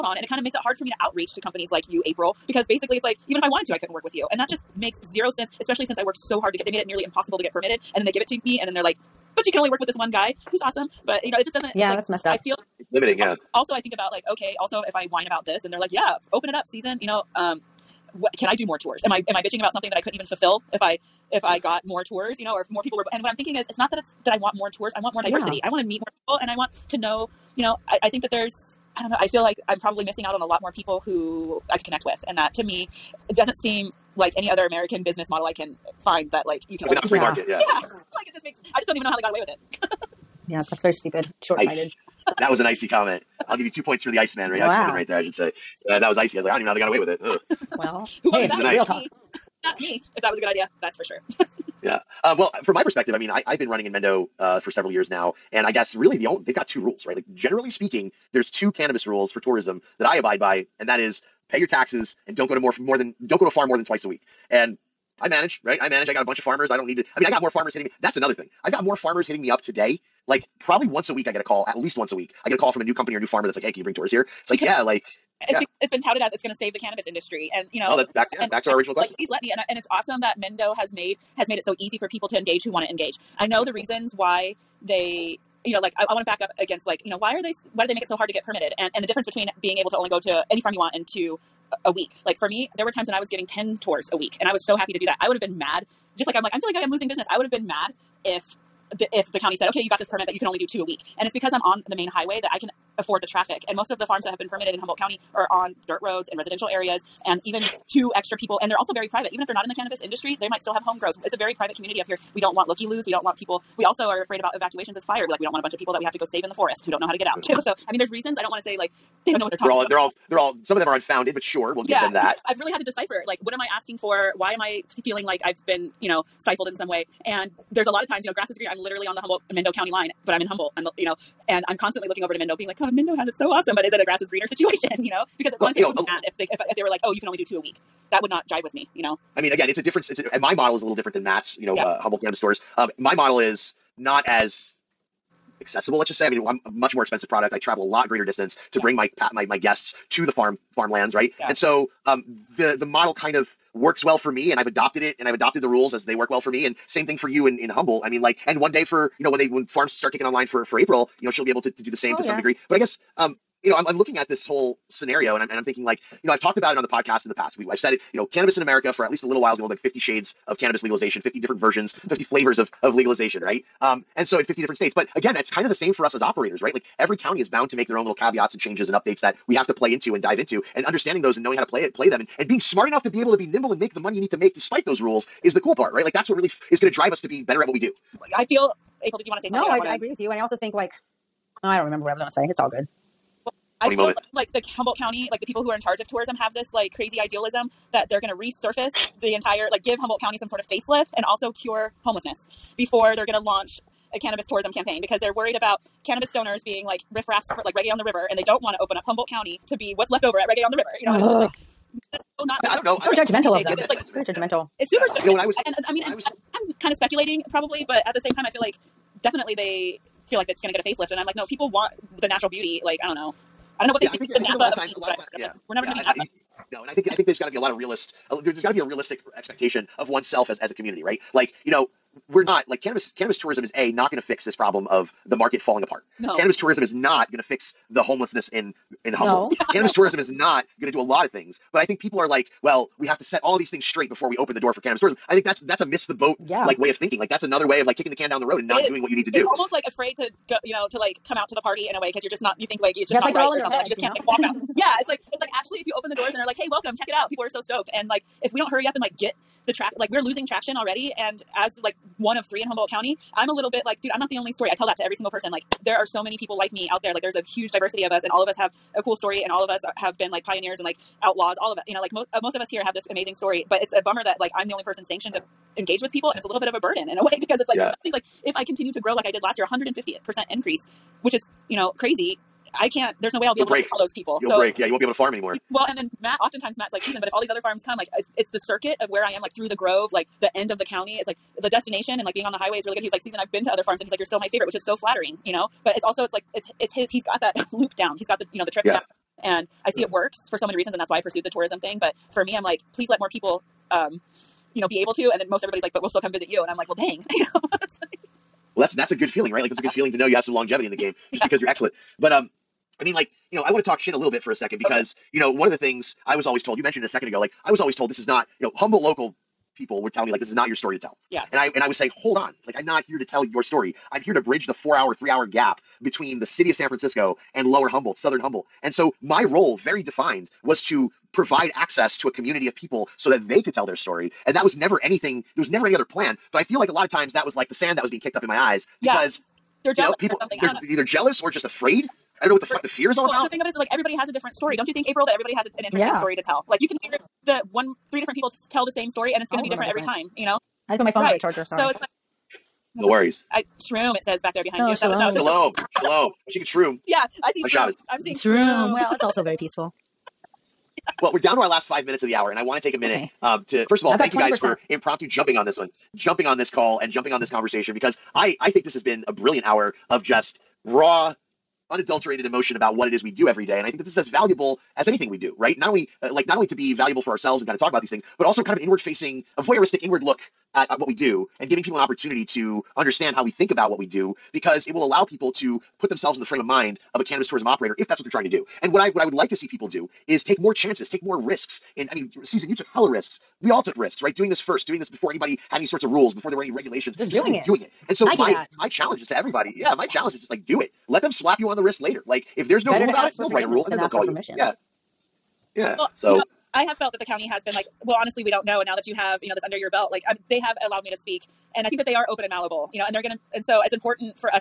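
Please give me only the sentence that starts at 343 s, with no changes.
The thing of it is, like everybody has a different story.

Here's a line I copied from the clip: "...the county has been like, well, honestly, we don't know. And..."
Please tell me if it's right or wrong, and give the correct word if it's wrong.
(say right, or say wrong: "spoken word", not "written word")
right.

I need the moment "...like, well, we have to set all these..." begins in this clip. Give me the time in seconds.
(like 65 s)
242 s.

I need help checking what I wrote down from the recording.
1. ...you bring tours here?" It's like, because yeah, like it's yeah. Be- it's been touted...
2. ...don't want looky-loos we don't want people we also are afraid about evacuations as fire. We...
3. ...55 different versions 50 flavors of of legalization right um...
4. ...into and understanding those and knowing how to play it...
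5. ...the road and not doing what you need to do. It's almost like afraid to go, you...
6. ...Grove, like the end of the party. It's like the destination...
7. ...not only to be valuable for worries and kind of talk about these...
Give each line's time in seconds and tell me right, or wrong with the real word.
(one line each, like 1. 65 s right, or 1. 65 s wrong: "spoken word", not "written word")
1. 73 s right
2. 112 s right
3. 171 s wrong: "50", not "55"
4. 180 s right
5. 248 s right
6. 289 s wrong: "county", not "party"
7. 376 s wrong: "ourselves", not "worries".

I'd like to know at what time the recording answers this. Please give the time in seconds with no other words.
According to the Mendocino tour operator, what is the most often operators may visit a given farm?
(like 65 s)
63 s.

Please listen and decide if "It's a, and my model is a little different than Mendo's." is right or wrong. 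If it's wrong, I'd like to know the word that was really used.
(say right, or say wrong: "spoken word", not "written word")
wrong: "Matt", not "Mendo".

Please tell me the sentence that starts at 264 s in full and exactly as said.
I tell that to every single person.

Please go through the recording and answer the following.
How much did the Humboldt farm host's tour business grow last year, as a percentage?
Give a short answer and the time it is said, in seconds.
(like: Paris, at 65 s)
150%, at 279 s.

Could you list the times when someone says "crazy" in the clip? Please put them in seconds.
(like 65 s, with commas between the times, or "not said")
196 s, 281 s.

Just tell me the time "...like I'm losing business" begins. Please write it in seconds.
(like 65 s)
96 s.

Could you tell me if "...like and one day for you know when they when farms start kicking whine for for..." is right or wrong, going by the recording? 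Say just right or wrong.
wrong.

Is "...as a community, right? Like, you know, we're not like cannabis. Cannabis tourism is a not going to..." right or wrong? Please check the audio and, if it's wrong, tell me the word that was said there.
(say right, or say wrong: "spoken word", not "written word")
right.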